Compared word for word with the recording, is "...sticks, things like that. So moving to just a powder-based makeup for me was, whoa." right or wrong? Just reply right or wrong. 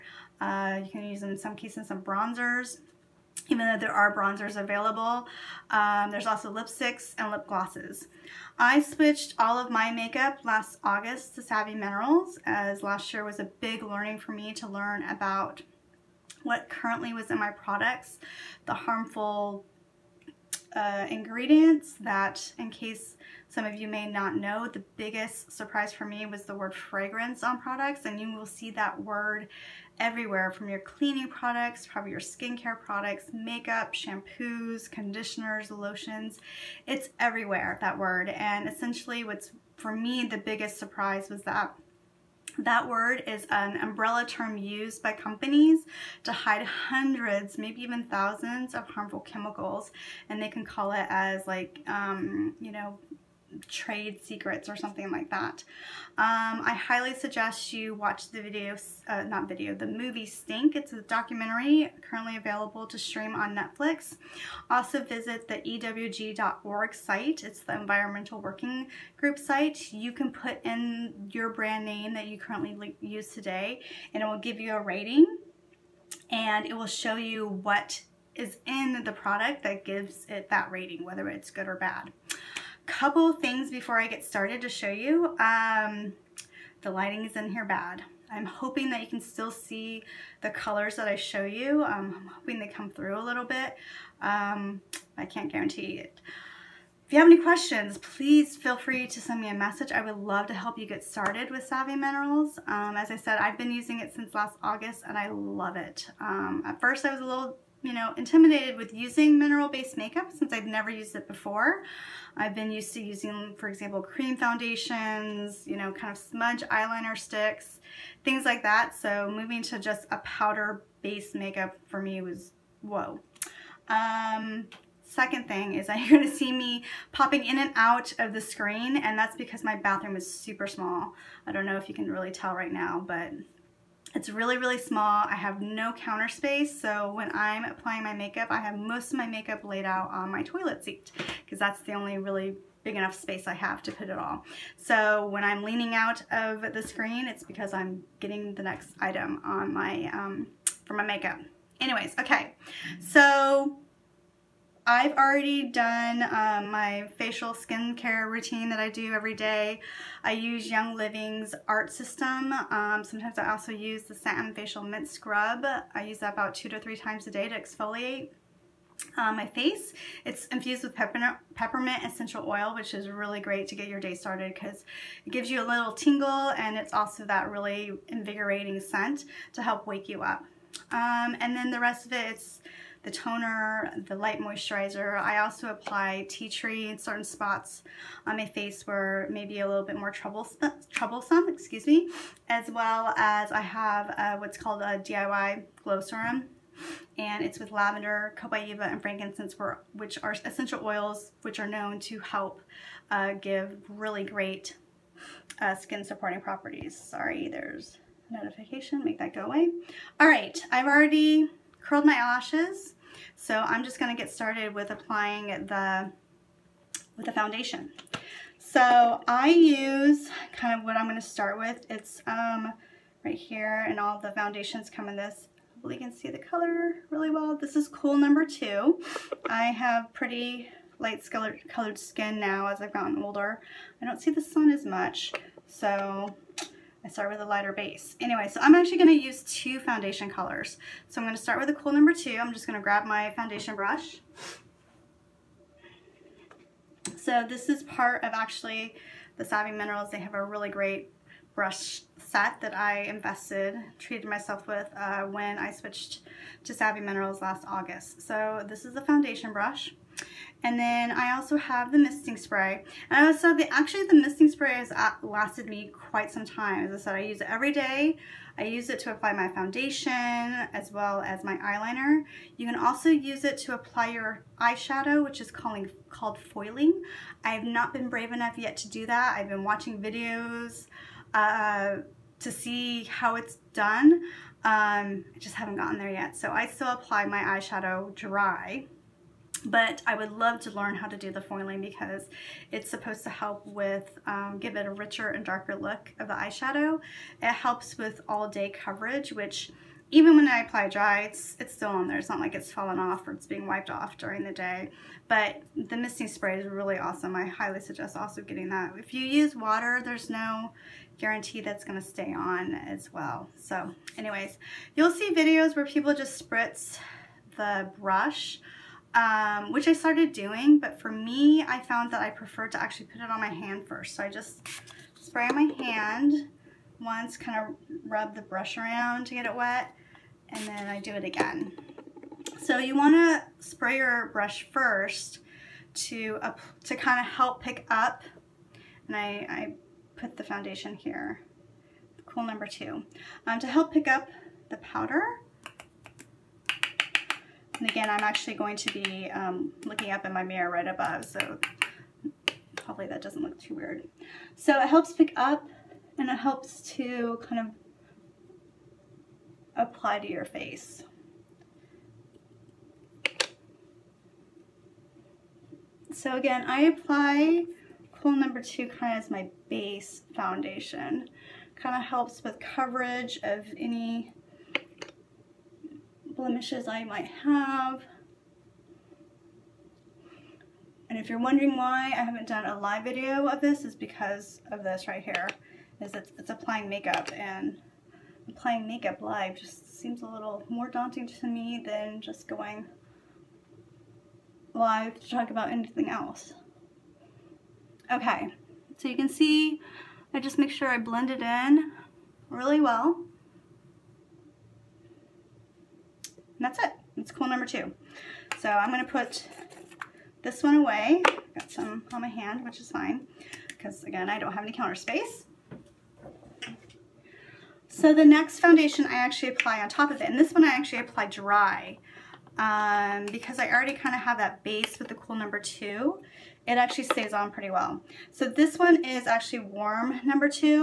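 right.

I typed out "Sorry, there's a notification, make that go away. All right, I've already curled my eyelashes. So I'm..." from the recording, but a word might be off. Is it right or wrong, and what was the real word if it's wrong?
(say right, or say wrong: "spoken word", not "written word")
right.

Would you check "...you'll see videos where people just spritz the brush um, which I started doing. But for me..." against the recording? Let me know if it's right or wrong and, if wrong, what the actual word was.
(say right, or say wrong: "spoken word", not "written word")
right.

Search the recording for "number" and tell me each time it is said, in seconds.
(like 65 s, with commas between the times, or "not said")
228 s, 241 s, 342 s, 368 s, 407 s, 425 s, 430 s.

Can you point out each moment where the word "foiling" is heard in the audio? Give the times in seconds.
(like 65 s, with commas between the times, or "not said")
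276 s, 291 s.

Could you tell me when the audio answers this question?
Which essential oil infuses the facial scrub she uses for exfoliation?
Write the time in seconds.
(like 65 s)
171 s.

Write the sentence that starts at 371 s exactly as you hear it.
Kind of helps with coverage of any blemishes I might have.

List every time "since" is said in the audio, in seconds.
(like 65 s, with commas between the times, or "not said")
104 s, 110 s.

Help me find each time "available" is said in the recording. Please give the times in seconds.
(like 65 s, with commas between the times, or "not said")
4 s, 62 s.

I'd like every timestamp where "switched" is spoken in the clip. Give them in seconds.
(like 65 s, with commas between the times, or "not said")
8 s, 255 s.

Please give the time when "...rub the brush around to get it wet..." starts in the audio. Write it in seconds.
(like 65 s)
328 s.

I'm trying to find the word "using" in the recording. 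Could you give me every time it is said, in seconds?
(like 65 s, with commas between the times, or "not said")
103 s, 108 s, 113 s.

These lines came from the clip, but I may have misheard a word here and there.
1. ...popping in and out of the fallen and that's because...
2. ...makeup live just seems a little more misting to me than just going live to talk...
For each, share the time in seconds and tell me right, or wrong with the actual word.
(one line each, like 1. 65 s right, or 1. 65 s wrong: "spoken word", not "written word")
1. 127 s wrong: "screen", not "fallen"
2. 388 s wrong: "daunting", not "misting".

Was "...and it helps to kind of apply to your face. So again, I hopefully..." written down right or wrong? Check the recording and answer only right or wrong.
wrong.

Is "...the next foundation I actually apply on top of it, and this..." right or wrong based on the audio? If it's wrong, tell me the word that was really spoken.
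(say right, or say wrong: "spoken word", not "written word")
right.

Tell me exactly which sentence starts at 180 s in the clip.
Um, and then the rest of it, it's the toner, the light moisturizer.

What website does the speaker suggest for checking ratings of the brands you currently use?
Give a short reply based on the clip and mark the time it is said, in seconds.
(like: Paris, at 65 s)
EWG.org, at 65 s.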